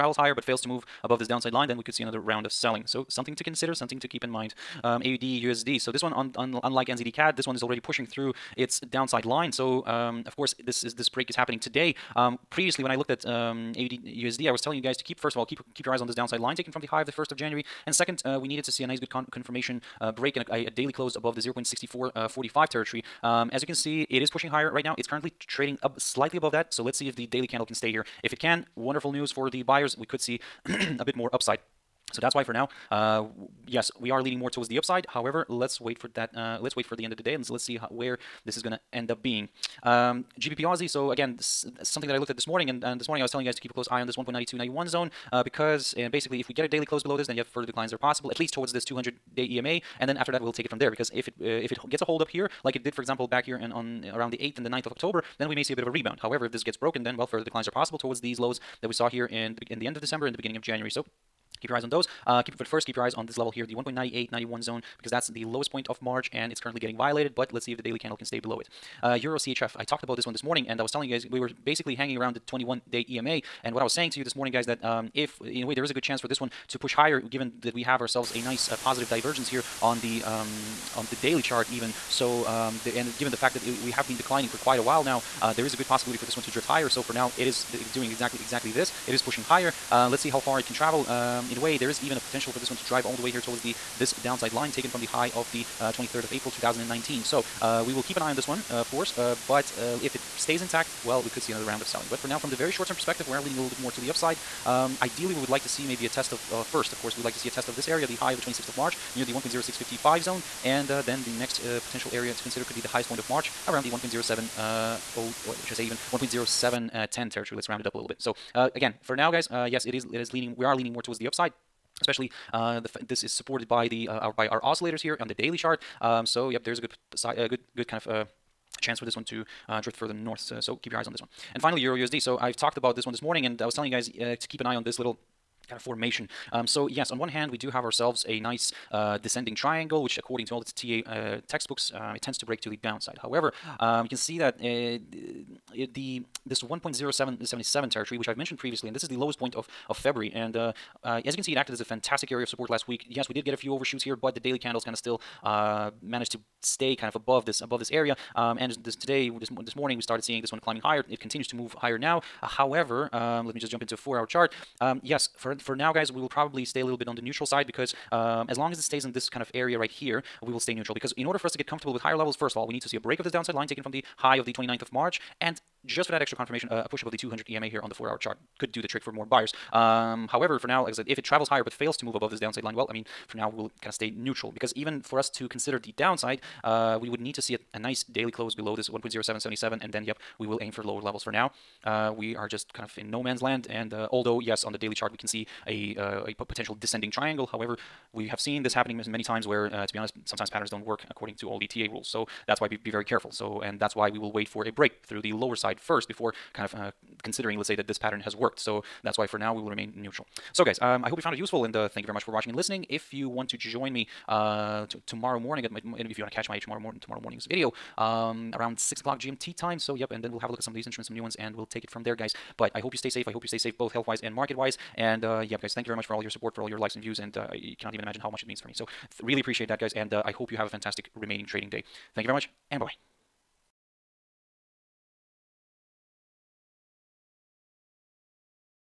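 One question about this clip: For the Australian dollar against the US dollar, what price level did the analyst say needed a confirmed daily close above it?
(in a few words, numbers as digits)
0.6445.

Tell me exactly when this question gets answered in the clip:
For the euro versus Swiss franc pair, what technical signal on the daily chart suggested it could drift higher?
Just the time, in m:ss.
1:18.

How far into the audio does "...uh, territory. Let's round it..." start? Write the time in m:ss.
1:56.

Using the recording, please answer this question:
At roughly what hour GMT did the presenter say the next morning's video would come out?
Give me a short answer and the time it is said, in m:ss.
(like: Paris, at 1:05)
6 o'clock, at 3:38.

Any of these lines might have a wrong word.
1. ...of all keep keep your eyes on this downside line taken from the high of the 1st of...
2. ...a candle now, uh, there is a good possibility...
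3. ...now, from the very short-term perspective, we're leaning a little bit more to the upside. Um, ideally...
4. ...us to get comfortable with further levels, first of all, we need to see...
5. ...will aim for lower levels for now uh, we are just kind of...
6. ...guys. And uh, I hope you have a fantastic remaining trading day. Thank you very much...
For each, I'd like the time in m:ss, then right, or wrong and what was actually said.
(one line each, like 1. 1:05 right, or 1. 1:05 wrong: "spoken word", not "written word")
1. 0:15 right
2. 1:24 wrong: "while", not "candle"
3. 1:42 right
4. 2:51 wrong: "higher", not "further"
5. 3:10 right
6. 3:49 right.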